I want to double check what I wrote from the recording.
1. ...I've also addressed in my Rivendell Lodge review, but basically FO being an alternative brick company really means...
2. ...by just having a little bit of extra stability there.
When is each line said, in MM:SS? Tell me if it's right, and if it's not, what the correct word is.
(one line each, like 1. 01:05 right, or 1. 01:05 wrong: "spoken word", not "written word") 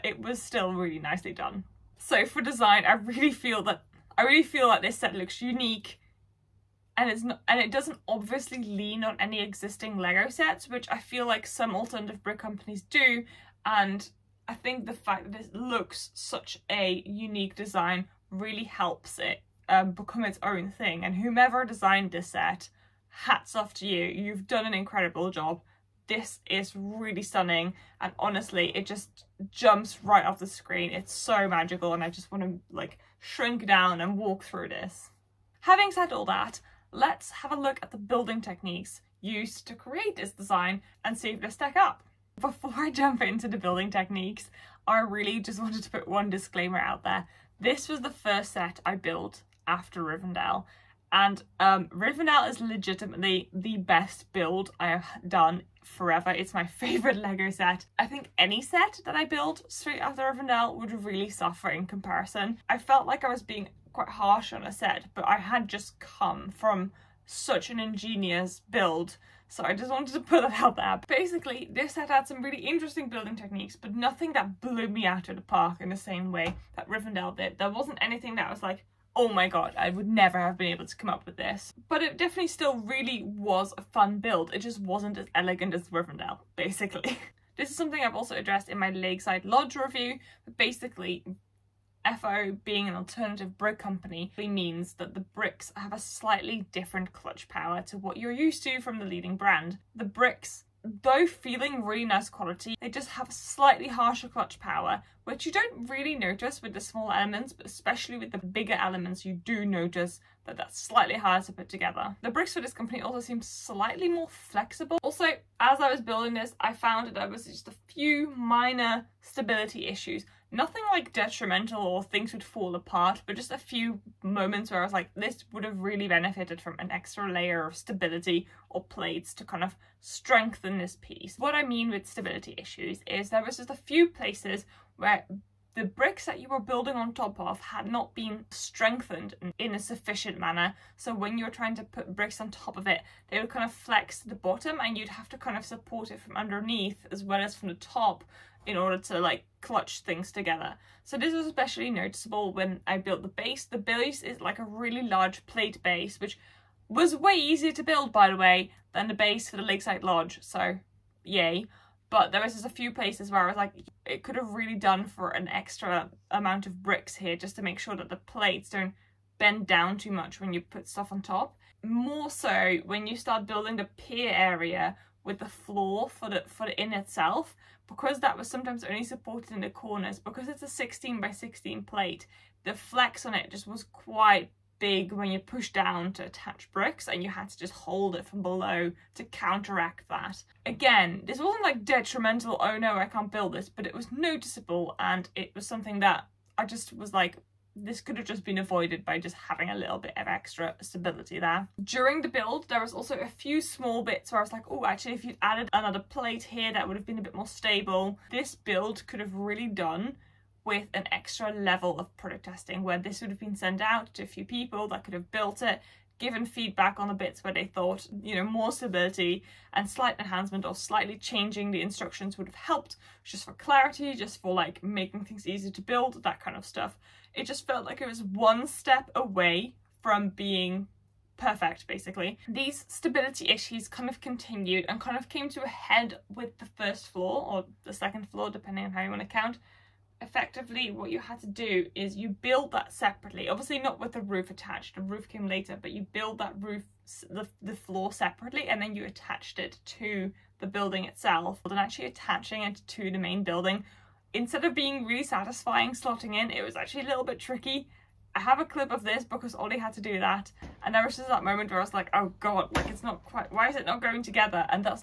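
1. 01:28 wrong: "Lakeside", not "Rivendell"
2. 03:19 right.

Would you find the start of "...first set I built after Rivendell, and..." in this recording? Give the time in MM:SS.
00:48.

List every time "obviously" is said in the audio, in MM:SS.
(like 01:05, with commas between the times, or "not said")
00:08, 04:03.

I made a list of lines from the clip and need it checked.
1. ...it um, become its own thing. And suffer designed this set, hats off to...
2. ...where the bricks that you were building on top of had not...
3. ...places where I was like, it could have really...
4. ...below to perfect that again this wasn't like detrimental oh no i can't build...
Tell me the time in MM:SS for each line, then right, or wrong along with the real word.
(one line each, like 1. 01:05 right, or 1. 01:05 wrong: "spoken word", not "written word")
1. 00:19 wrong: "whomever", not "suffer"
2. 02:14 right
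3. 02:42 right
4. 03:08 wrong: "counteract", not "perfect".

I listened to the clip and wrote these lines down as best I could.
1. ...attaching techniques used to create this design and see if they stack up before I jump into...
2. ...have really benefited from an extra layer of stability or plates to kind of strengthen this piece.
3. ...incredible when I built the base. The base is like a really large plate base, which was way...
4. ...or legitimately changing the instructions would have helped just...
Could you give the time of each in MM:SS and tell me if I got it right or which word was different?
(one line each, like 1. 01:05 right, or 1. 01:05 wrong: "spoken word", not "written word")
1. 00:37 wrong: "building", not "attaching"
2. 02:05 right
3. 02:31 wrong: "noticeable", not "incredible"
4. 03:40 wrong: "slightly", not "legitimately".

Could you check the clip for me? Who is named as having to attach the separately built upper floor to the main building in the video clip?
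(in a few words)
Ollie.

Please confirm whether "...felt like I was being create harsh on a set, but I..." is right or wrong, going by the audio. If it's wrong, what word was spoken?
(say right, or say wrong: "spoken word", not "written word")
wrong: "quite", not "create".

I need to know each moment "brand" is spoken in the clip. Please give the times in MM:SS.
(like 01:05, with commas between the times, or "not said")
01:39.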